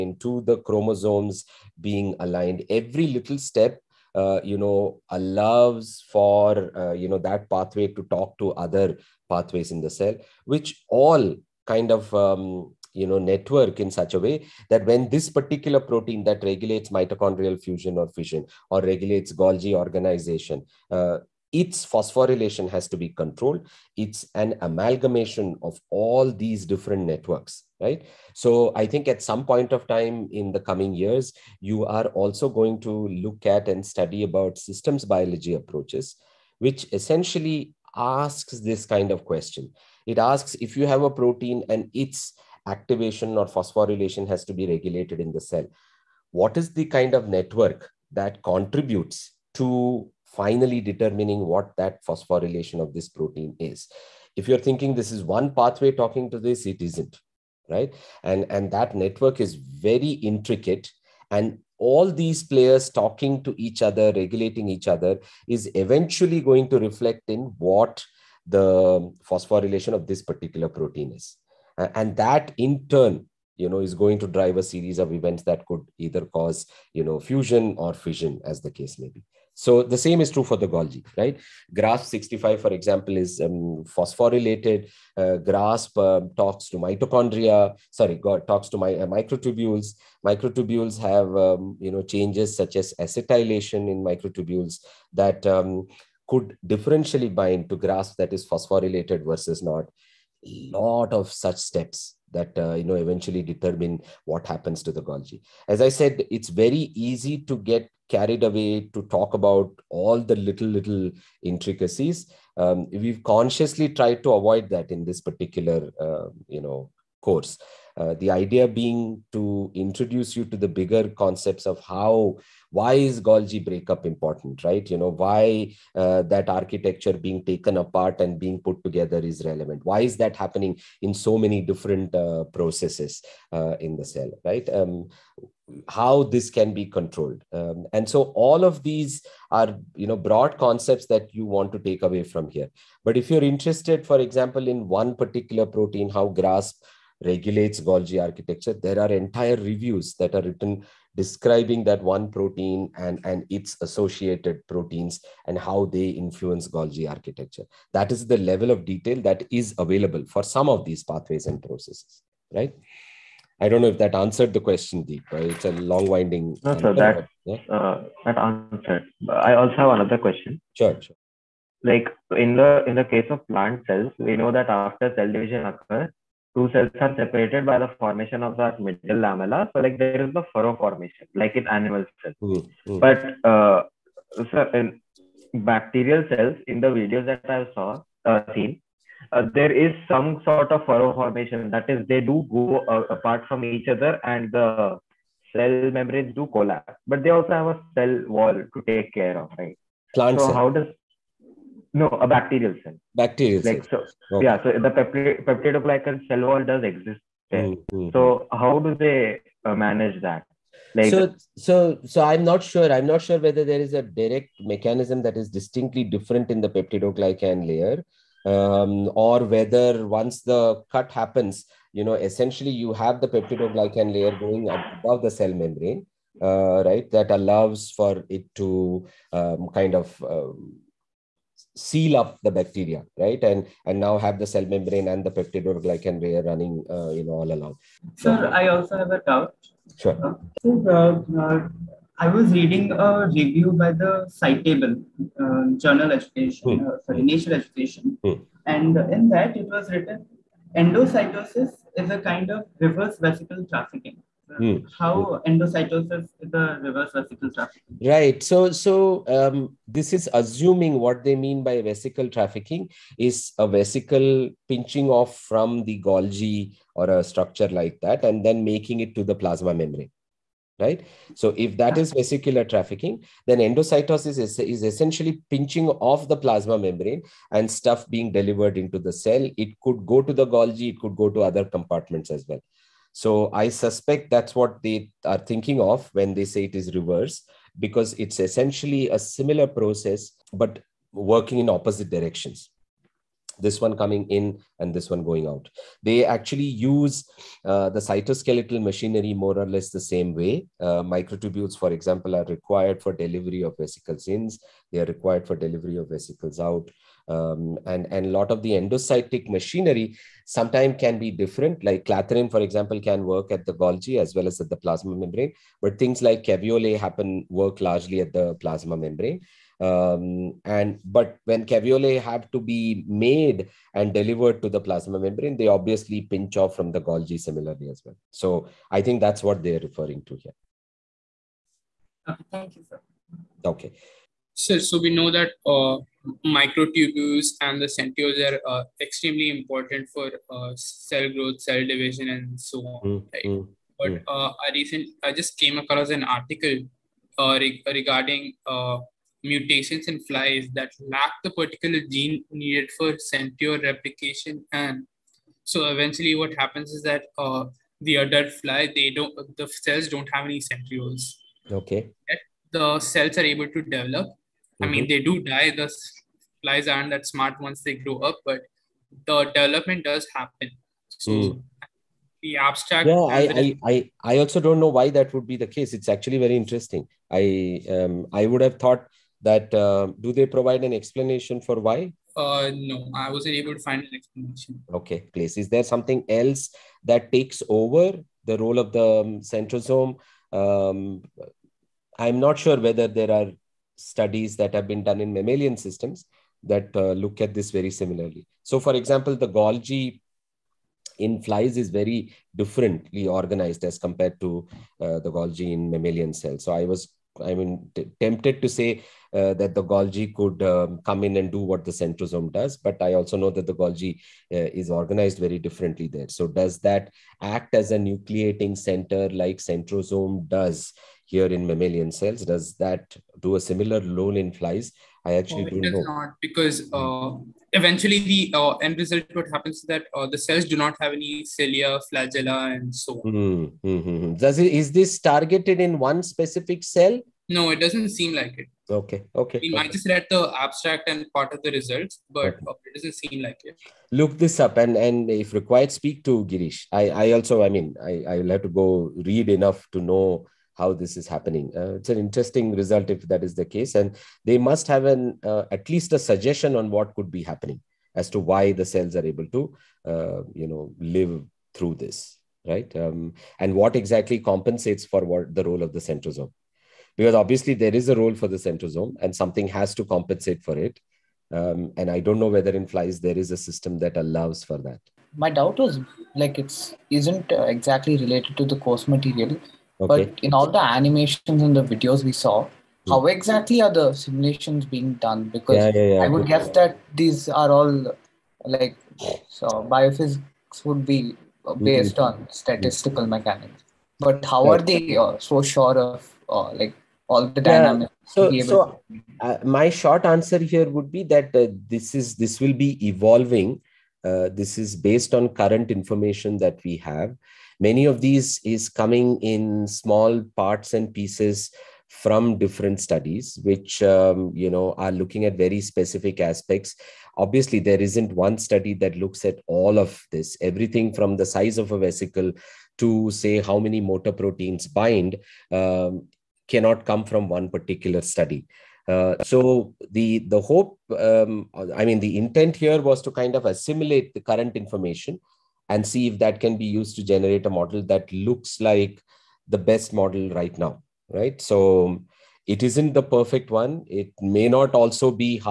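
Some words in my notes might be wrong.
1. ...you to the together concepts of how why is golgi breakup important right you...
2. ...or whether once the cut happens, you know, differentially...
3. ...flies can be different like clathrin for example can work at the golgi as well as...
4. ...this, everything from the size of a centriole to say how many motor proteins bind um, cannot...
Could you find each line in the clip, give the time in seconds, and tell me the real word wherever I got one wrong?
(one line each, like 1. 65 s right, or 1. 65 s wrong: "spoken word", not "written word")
1. 120 s wrong: "bigger", not "together"
2. 219 s wrong: "essentially", not "differentially"
3. 310 s wrong: "sometimes", not "flies"
4. 520 s wrong: "vesicle", not "centriole".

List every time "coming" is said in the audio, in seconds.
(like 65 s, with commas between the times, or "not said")
30 s, 293 s, 508 s.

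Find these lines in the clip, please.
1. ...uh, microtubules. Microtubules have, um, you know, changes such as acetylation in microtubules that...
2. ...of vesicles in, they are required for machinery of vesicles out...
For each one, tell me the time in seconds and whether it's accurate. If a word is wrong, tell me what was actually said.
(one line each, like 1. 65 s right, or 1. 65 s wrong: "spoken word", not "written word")
1. 88 s right
2. 303 s wrong: "delivery", not "machinery".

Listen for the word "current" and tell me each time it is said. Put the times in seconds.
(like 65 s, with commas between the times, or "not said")
505 s, 534 s.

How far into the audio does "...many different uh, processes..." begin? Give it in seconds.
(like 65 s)
131 s.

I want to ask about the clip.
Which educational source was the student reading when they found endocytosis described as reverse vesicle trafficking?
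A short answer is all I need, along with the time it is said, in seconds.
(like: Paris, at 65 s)
Scitable, at 244 s.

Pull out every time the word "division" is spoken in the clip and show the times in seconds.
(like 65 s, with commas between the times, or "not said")
175 s, 341 s.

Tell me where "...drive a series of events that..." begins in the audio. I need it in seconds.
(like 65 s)
74 s.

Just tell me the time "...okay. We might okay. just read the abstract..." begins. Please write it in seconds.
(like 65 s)
439 s.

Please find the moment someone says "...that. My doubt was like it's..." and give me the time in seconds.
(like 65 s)
474 s.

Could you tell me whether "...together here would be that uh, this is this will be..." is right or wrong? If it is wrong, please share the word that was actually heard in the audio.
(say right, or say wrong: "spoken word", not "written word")
wrong: "answer", not "together".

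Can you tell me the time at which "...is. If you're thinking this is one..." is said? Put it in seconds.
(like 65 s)
53 s.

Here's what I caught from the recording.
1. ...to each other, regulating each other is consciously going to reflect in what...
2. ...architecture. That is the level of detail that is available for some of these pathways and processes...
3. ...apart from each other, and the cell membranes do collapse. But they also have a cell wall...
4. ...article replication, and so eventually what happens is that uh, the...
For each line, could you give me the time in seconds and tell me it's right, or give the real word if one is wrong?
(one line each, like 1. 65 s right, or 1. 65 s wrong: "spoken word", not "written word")
1. 63 s wrong: "eventually", not "consciously"
2. 157 s right
3. 193 s right
4. 353 s wrong: "centriole", not "article".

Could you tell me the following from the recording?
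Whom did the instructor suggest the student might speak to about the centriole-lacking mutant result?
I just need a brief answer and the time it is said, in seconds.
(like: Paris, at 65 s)
Girish, at 446 s.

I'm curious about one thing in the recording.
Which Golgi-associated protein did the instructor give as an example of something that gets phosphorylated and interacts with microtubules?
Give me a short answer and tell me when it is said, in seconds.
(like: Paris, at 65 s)
GRASP 65, at 81 s.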